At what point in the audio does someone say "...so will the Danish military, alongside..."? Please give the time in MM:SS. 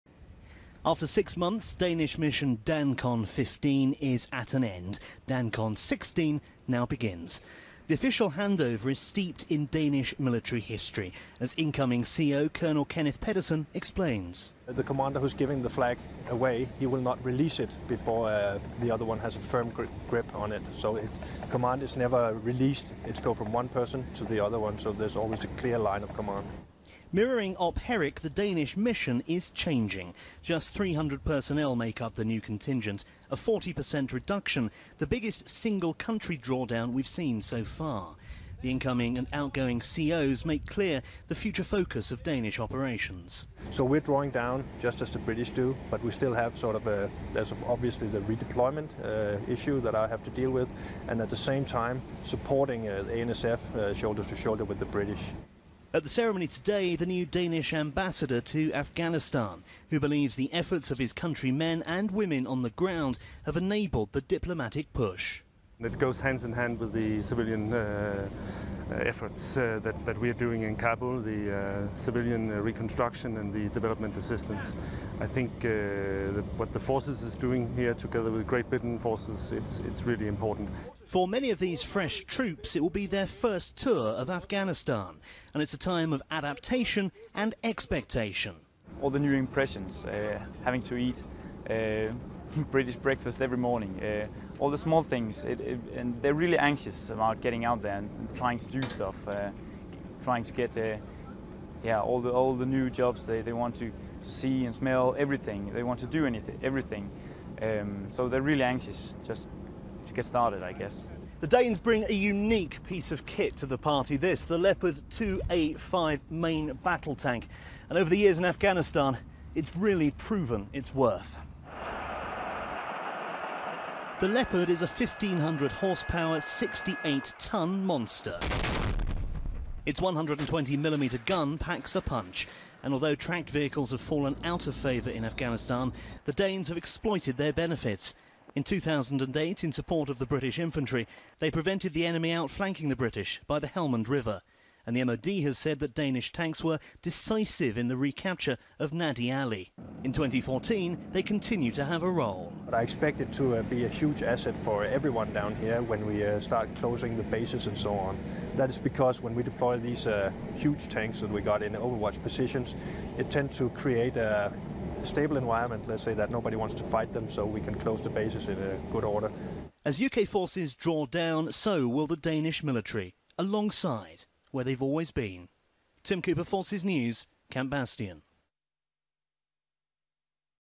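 02:51.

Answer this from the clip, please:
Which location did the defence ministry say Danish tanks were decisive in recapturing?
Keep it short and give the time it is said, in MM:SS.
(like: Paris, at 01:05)
Nad-e Ali, at 02:28.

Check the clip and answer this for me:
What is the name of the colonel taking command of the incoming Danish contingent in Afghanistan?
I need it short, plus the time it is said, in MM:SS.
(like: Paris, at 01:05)
Kenneth Pedersen, at 00:12.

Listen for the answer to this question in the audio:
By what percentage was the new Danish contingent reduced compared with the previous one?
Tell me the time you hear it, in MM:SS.
00:33.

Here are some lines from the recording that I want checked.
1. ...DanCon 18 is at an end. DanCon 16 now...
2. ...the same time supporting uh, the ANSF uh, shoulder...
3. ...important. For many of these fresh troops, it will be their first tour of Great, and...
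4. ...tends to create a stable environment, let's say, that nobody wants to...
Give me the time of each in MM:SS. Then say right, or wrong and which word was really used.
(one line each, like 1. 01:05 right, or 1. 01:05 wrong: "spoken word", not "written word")
1. 00:02 wrong: "15", not "18"
2. 00:51 right
3. 01:20 wrong: "Afghanistan", not "Great"
4. 02:43 right.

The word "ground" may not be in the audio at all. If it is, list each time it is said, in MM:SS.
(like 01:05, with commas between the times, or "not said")
01:02.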